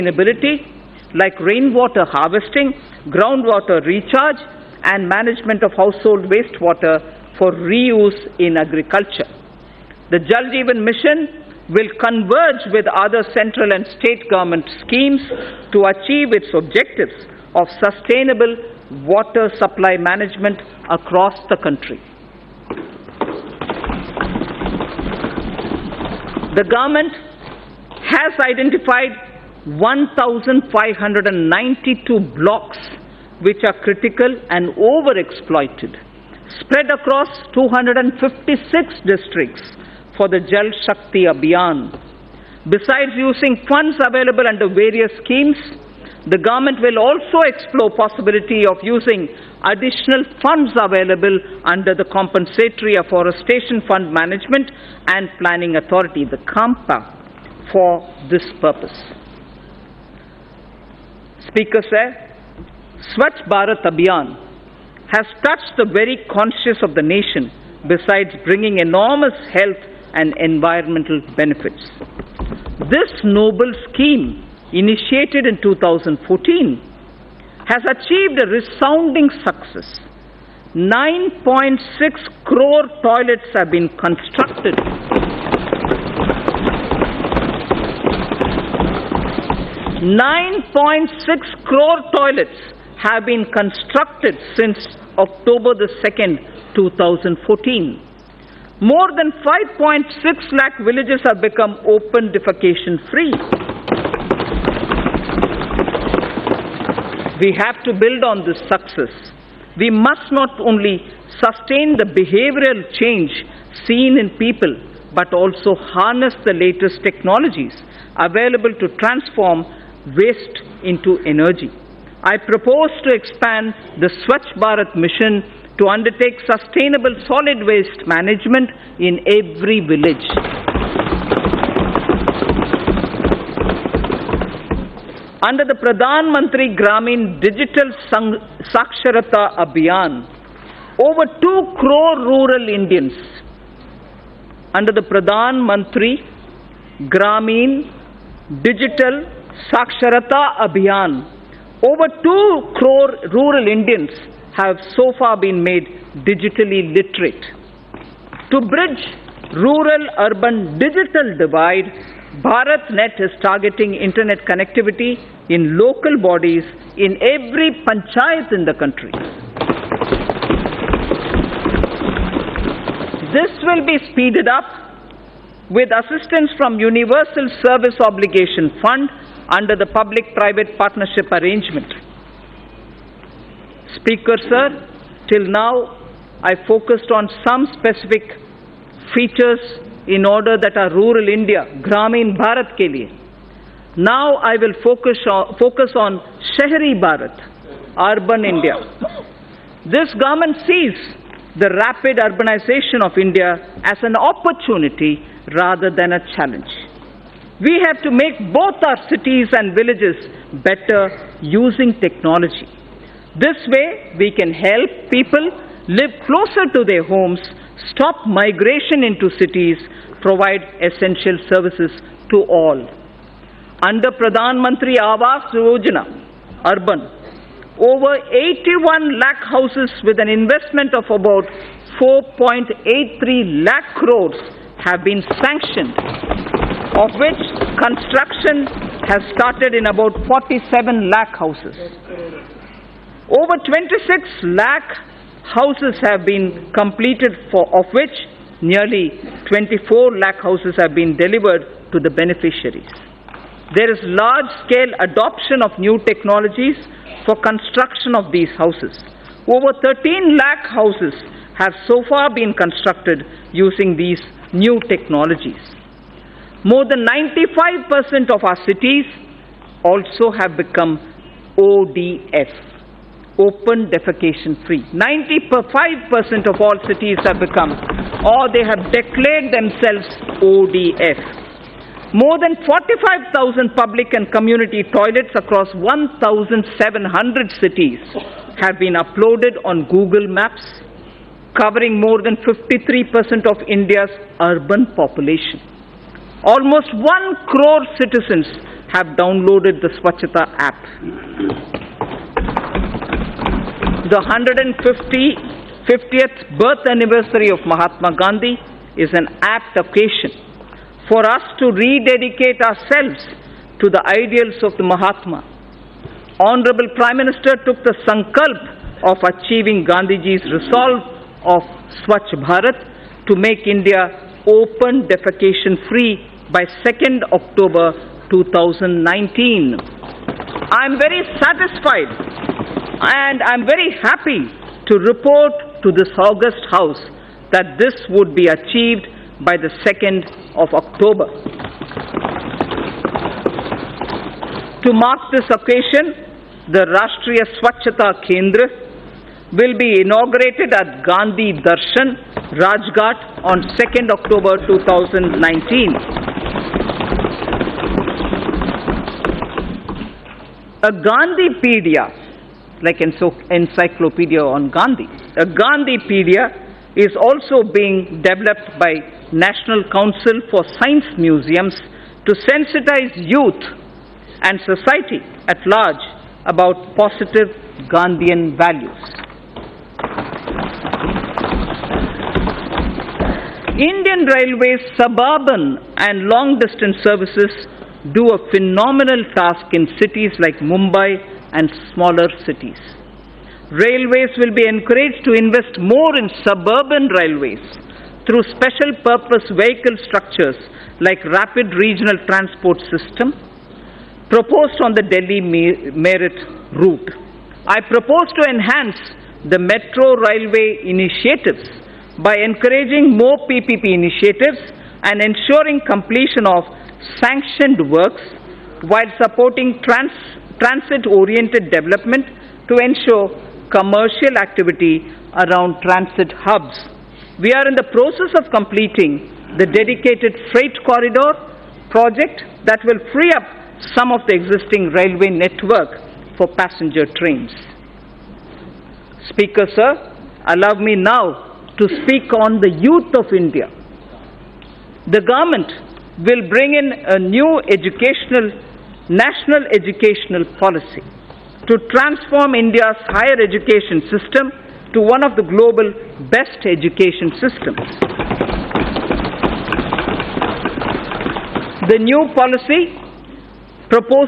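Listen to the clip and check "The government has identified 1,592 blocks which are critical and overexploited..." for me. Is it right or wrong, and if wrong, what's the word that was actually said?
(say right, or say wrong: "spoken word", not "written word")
right.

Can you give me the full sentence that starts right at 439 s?
Speaker sir, allow me now to speak on the youth of India.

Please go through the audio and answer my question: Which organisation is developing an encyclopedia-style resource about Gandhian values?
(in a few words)
National Council for Science Museums.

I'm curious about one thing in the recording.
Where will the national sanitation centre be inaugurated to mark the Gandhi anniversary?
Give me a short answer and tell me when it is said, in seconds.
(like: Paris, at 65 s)
Gandhi Darshan, Rajghat, at 351 s.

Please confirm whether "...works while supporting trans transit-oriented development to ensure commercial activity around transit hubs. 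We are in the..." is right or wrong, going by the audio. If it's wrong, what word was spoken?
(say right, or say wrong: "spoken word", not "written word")
right.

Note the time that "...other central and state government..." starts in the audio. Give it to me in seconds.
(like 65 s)
12 s.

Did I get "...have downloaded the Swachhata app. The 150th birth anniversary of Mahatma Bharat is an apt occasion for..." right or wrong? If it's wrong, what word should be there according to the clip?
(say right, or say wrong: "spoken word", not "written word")
wrong: "Gandhi", not "Bharat".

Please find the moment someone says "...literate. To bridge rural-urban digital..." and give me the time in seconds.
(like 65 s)
156 s.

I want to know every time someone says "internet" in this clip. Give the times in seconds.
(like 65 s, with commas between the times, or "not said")
163 s.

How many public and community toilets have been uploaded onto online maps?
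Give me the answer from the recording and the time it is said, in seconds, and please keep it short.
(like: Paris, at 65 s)
45,000, at 282 s.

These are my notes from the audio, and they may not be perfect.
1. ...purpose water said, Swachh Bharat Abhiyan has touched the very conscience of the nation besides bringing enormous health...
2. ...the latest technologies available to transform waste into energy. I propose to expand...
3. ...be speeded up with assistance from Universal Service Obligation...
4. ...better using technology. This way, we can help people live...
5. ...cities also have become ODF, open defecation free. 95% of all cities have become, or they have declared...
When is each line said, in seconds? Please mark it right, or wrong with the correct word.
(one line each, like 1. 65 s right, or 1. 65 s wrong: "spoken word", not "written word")
1. 58 s wrong: "speaker", not "water"
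2. 116 s right
3. 173 s right
4. 210 s right
5. 268 s right.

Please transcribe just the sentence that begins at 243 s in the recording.
Over 26 lakh houses have been completed, for, of which nearly 24 lakh houses have been delivered to the beneficiaries.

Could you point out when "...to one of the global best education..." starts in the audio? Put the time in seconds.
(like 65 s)
454 s.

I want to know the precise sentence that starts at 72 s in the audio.
This noble scheme, initiated in 2014, has achieved a resounding success.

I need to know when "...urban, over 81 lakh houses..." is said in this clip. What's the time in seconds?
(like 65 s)
226 s.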